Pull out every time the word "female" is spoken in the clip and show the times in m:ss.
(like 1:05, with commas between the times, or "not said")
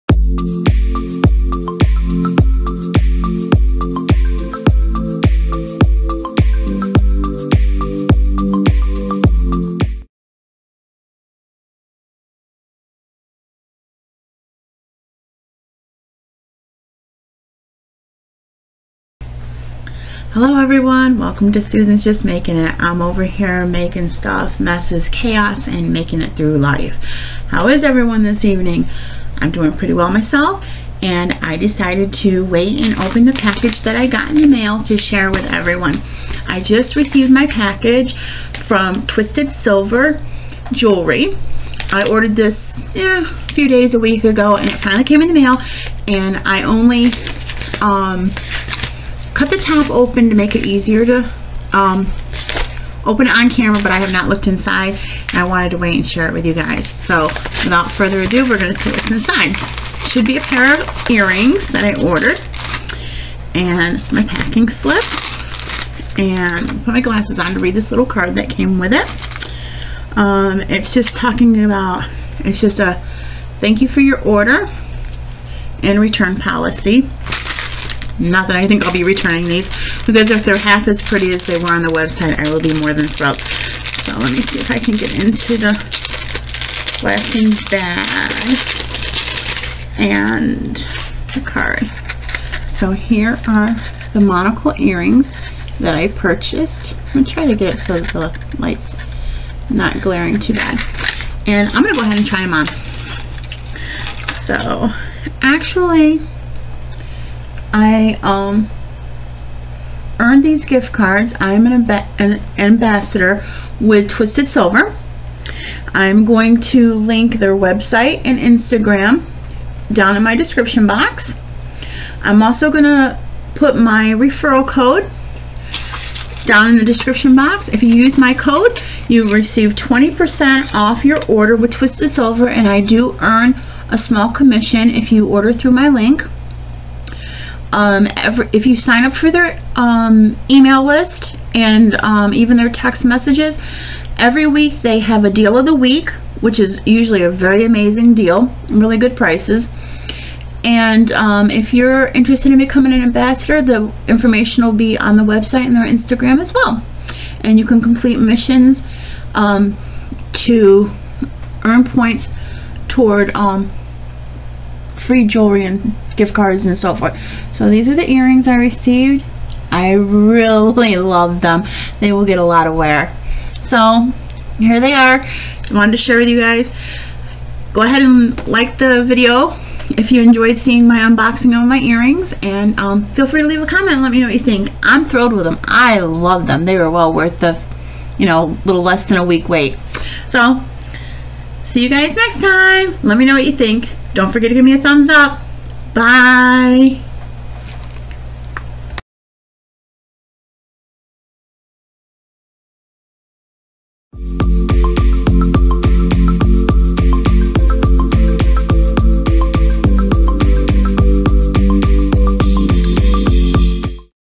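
not said.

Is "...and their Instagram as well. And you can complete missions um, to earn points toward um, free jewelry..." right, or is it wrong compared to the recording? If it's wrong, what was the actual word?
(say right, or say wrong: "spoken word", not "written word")
right.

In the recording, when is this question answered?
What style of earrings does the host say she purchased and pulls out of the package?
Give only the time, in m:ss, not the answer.
1:34.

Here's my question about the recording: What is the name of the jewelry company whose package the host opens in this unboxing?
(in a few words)
Twisted Silver Jewelry.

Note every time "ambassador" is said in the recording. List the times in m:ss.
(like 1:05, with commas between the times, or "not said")
1:52, 2:33.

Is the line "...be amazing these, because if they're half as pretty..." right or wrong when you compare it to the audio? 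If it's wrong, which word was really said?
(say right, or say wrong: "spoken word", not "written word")
wrong: "returning", not "amazing".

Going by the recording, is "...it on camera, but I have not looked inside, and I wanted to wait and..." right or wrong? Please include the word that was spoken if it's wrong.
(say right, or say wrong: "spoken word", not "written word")
right.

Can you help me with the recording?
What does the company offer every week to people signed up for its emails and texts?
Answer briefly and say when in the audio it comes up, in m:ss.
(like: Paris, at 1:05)
deal of the week, at 2:25.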